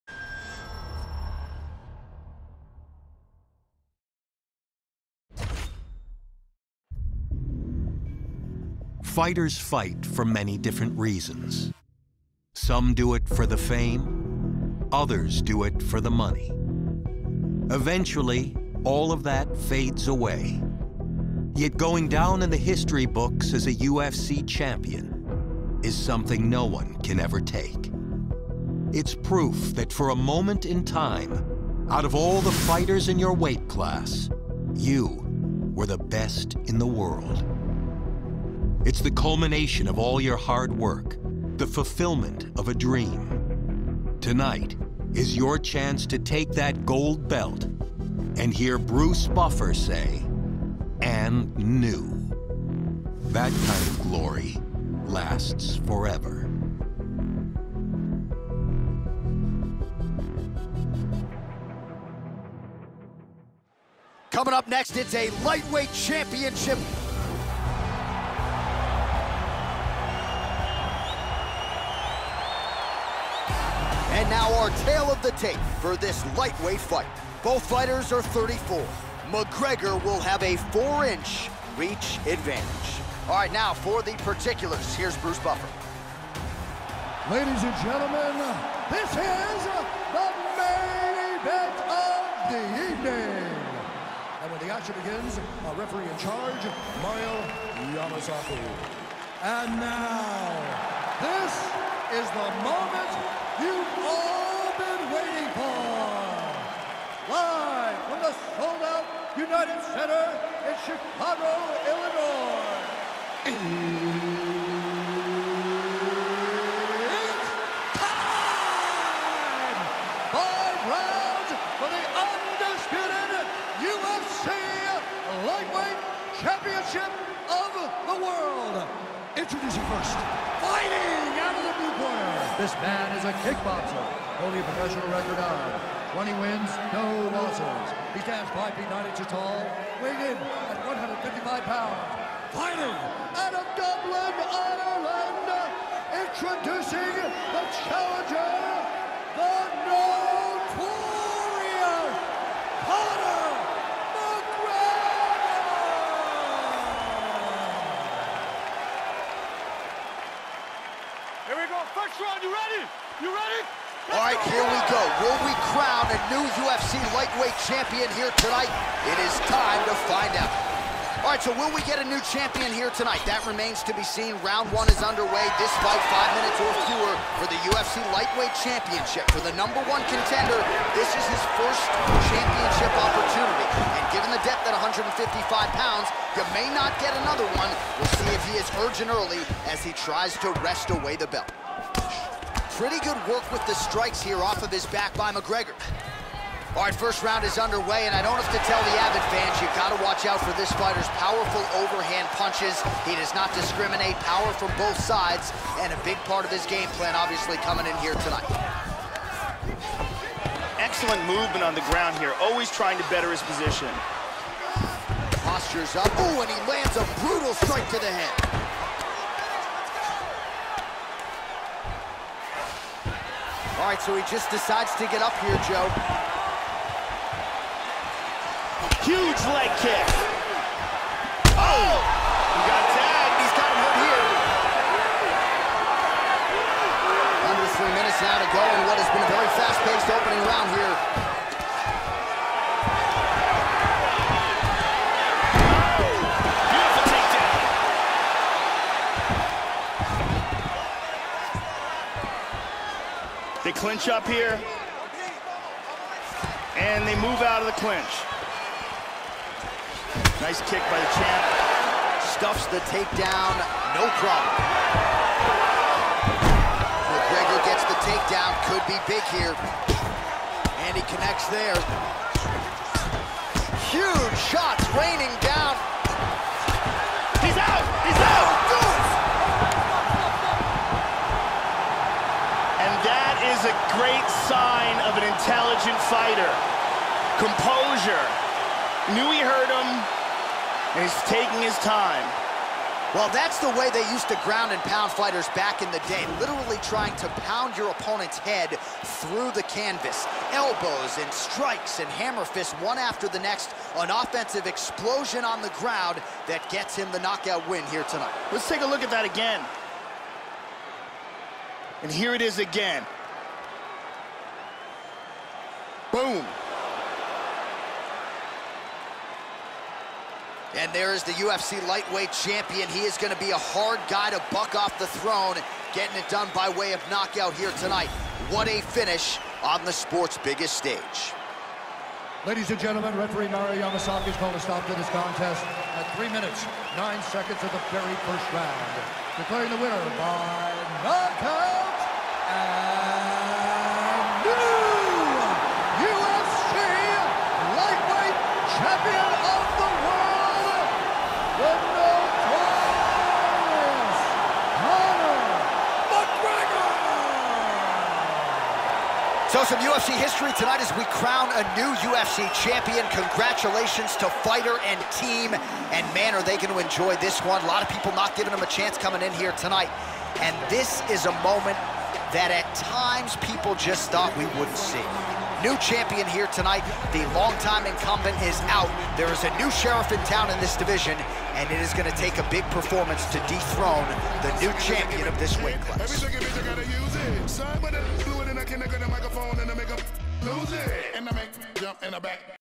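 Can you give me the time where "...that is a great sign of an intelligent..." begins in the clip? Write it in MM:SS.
04:43.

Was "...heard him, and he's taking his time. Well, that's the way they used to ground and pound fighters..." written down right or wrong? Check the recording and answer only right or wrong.
right.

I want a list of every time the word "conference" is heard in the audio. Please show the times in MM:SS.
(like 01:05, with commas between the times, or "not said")
not said.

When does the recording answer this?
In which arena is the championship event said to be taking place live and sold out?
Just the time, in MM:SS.
01:49.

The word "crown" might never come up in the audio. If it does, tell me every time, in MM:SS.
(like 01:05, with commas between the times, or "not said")
02:45, 06:01.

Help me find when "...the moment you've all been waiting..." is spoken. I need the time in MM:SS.
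01:42.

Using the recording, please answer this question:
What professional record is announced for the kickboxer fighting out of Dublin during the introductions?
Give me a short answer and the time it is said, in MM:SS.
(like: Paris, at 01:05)
20 wins, no losses, at 02:16.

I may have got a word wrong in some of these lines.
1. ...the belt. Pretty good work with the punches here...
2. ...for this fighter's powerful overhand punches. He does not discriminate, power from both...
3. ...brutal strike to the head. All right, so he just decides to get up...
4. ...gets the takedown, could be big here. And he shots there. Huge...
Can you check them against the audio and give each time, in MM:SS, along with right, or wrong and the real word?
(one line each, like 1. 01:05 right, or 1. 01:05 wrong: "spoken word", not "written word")
1. 03:11 wrong: "strikes", not "punches"
2. 03:20 right
3. 03:37 right
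4. 04:27 wrong: "connects", not "shots".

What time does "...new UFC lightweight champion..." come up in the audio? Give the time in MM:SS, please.
02:46.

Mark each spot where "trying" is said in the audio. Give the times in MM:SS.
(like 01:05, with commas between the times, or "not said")
03:32, 04:56.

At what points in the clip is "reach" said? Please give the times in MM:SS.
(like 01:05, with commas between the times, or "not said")
01:21.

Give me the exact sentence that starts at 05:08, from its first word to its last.
Let's take a look at that again.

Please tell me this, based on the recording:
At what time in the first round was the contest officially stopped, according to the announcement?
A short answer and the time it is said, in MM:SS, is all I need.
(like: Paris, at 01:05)
3 minutes, 9 seconds, at 05:36.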